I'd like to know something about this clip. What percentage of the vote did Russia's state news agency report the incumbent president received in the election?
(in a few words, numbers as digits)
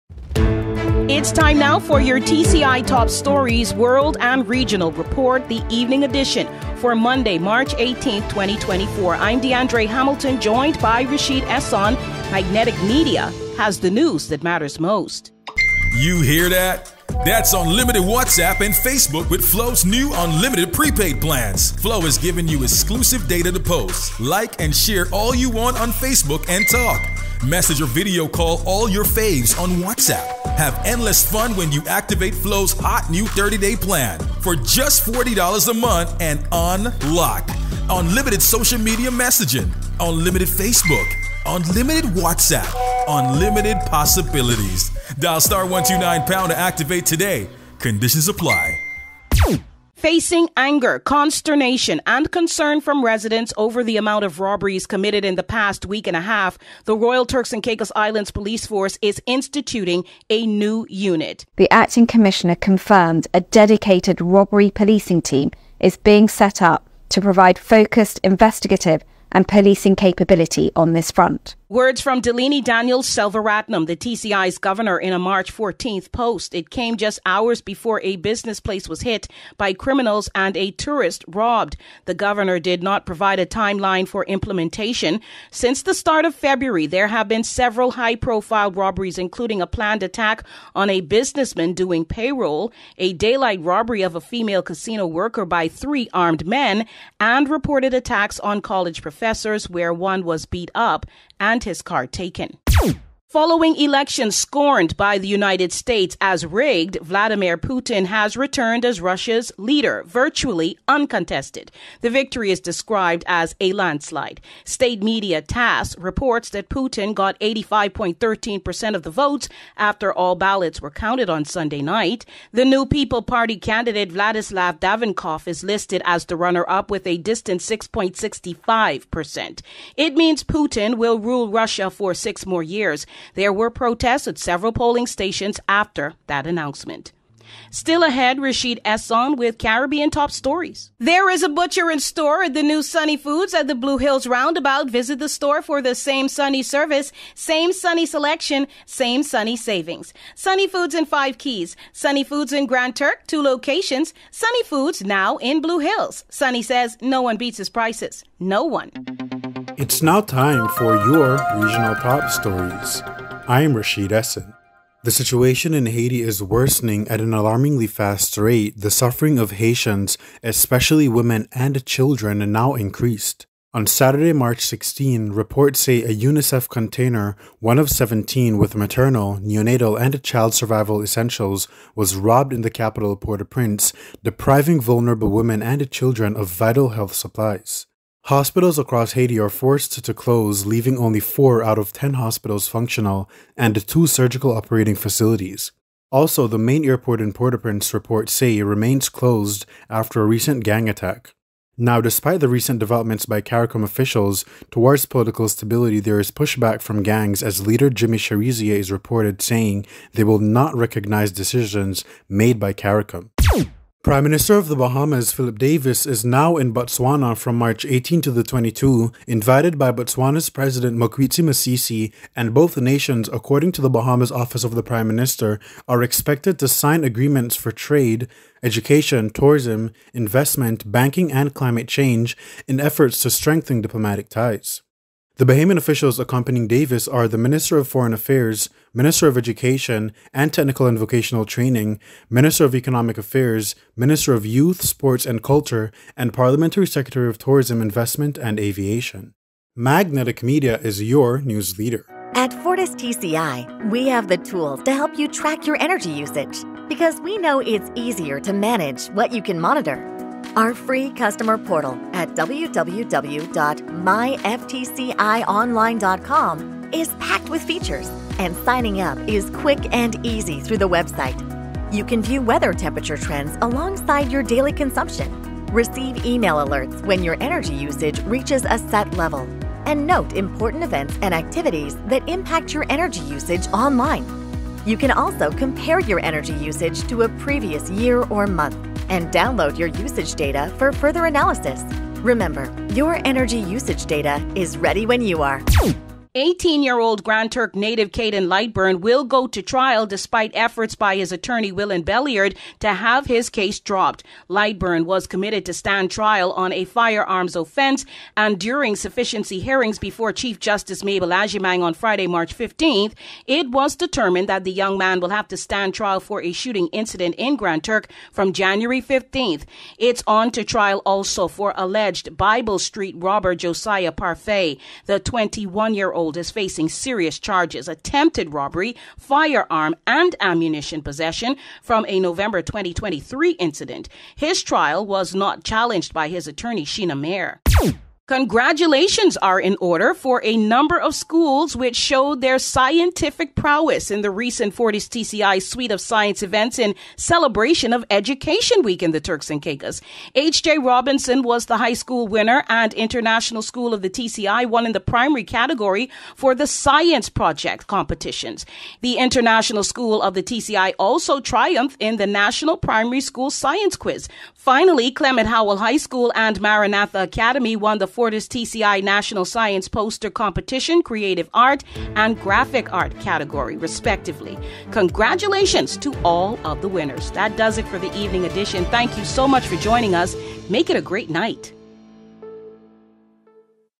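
85.13%.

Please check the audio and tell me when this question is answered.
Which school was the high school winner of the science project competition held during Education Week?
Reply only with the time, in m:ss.
5:50.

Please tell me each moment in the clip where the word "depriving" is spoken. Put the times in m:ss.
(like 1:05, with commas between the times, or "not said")
3:04.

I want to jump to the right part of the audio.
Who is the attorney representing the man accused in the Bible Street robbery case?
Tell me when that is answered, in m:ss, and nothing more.
5:36.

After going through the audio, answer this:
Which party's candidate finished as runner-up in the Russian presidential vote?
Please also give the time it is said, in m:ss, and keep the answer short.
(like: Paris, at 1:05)
New People Party, at 2:02.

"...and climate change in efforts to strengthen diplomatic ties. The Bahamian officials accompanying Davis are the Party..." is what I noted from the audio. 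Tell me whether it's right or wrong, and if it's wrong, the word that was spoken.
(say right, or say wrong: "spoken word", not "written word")
wrong: "Minister", not "Party".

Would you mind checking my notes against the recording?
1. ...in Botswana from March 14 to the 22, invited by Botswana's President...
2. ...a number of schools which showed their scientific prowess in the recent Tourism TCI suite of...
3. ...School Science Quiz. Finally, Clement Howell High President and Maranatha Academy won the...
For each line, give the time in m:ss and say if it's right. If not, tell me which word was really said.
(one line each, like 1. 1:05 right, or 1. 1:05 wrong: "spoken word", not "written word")
1. 3:36 wrong: "18", not "14"
2. 5:40 wrong: "Fortis", not "Tourism"
3. 6:03 wrong: "School", not "President".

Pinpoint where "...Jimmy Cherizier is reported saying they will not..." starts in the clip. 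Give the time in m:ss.
3:27.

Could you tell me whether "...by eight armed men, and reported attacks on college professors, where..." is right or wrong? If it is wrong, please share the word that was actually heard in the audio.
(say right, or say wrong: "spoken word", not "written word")
wrong: "three", not "eight".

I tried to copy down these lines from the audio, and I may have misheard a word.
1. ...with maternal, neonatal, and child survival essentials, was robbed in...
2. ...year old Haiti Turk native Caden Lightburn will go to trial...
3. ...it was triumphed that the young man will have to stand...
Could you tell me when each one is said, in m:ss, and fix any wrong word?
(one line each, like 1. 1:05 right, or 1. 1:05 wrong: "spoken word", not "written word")
1. 2:58 right
2. 4:56 wrong: "Grand", not "Haiti"
3. 5:13 wrong: "determined", not "triumphed".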